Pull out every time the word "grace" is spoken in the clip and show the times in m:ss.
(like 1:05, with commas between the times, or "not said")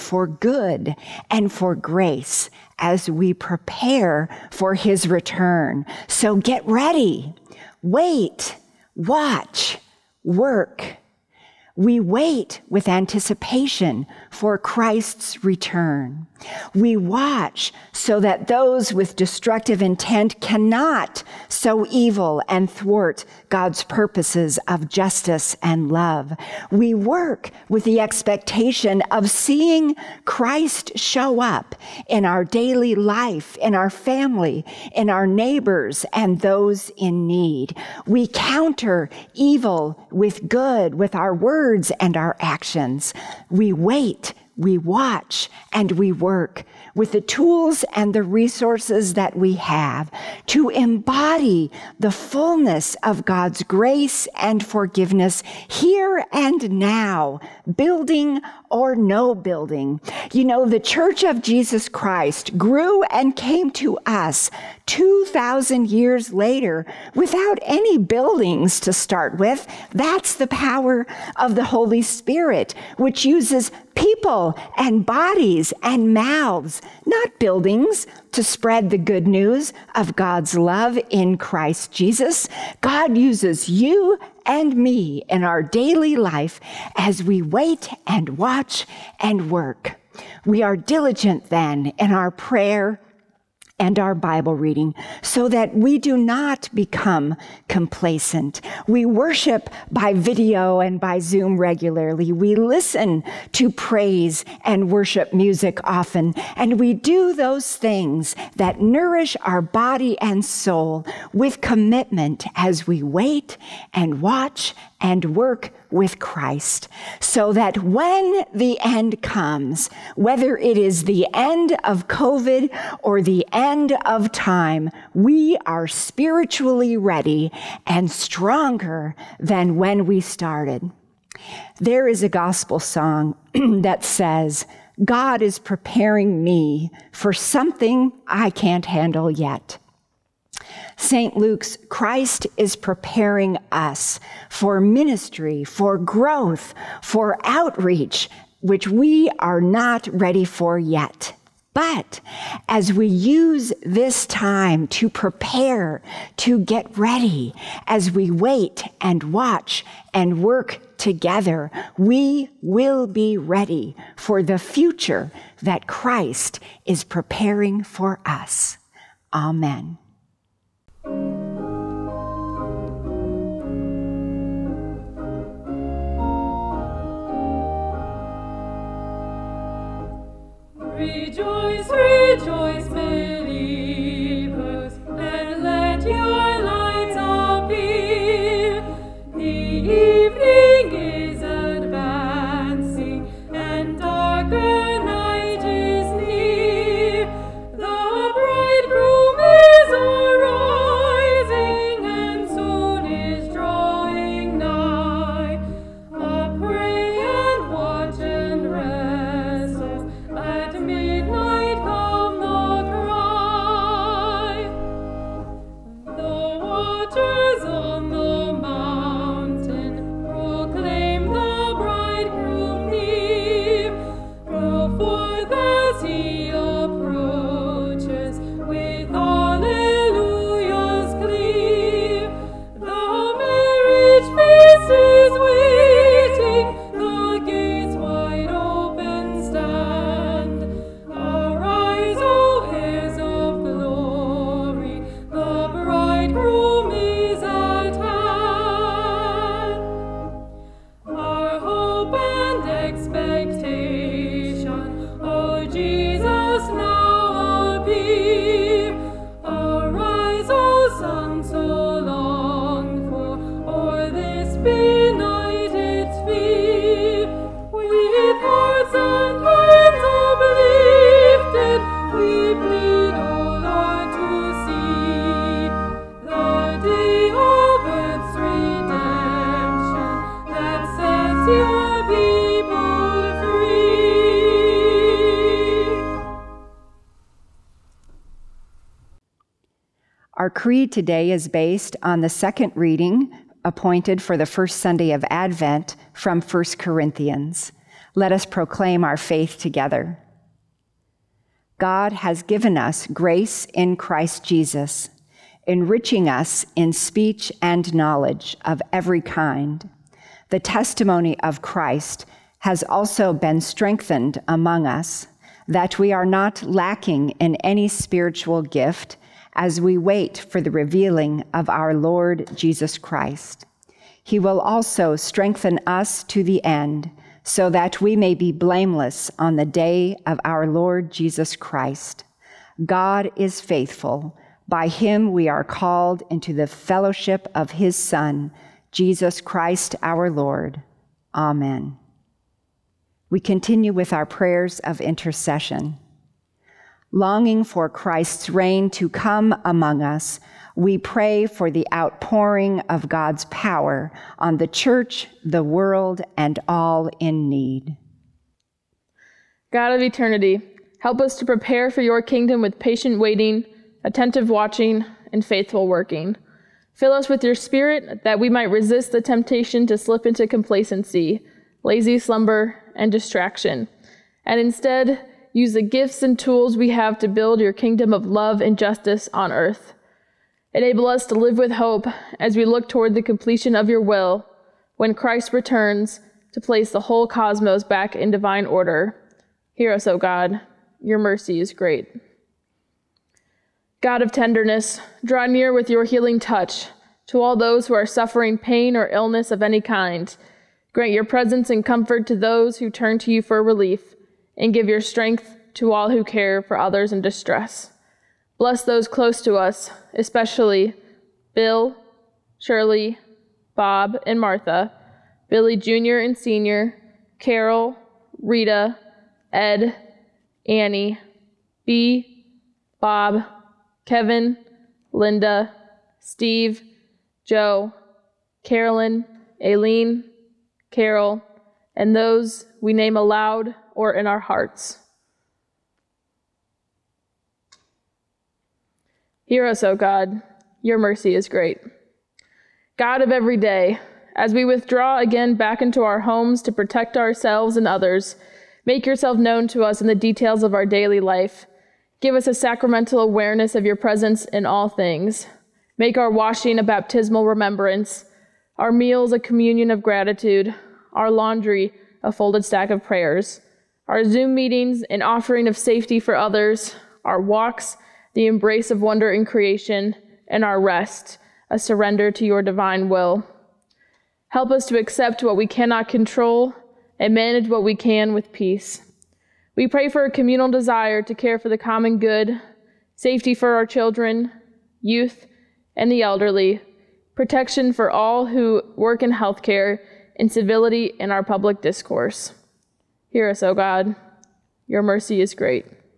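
0:01, 0:53, 5:03.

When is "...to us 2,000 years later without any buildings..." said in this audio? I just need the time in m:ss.
1:03.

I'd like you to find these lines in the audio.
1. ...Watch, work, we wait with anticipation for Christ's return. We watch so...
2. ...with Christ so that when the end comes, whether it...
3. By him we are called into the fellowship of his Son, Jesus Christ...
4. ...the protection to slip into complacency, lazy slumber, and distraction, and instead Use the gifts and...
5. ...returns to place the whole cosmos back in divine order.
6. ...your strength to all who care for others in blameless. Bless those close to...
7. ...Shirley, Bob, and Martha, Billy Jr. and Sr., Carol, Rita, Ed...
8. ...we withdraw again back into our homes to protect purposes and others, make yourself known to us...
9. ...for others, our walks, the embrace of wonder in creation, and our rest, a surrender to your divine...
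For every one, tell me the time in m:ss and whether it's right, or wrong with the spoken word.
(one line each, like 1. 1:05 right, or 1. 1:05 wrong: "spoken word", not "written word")
1. 0:08 right
2. 1:55 right
3. 5:34 right
4. 6:09 wrong: "temptation", not "protection"
5. 6:25 right
6. 6:44 wrong: "distress", not "blameless"
7. 6:52 right
8. 7:24 wrong: "ourselves", not "purposes"
9. 7:46 right.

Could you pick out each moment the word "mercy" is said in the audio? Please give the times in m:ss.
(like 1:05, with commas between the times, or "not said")
6:31, 7:20, 8:15.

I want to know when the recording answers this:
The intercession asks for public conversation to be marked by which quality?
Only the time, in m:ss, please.
8:10.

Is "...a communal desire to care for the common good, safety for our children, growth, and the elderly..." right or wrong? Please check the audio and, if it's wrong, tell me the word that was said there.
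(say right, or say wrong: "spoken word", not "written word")
wrong: "youth", not "growth".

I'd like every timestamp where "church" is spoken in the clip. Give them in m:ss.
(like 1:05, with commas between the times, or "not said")
1:00, 5:54.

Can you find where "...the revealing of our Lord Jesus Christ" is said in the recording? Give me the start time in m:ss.
5:20.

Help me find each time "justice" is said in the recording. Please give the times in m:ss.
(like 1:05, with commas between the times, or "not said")
0:24, 6:18.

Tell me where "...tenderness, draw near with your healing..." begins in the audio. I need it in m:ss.
6:34.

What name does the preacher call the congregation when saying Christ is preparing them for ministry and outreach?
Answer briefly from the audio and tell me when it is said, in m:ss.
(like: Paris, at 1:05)
St. Luke's, at 2:21.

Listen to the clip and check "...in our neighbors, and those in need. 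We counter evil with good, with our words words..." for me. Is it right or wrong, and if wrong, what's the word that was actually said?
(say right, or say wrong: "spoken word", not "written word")
right.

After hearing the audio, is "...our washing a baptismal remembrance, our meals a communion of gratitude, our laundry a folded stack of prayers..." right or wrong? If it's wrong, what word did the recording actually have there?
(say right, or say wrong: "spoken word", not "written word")
right.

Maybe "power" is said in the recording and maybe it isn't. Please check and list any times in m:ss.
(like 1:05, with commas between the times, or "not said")
1:10, 5:53.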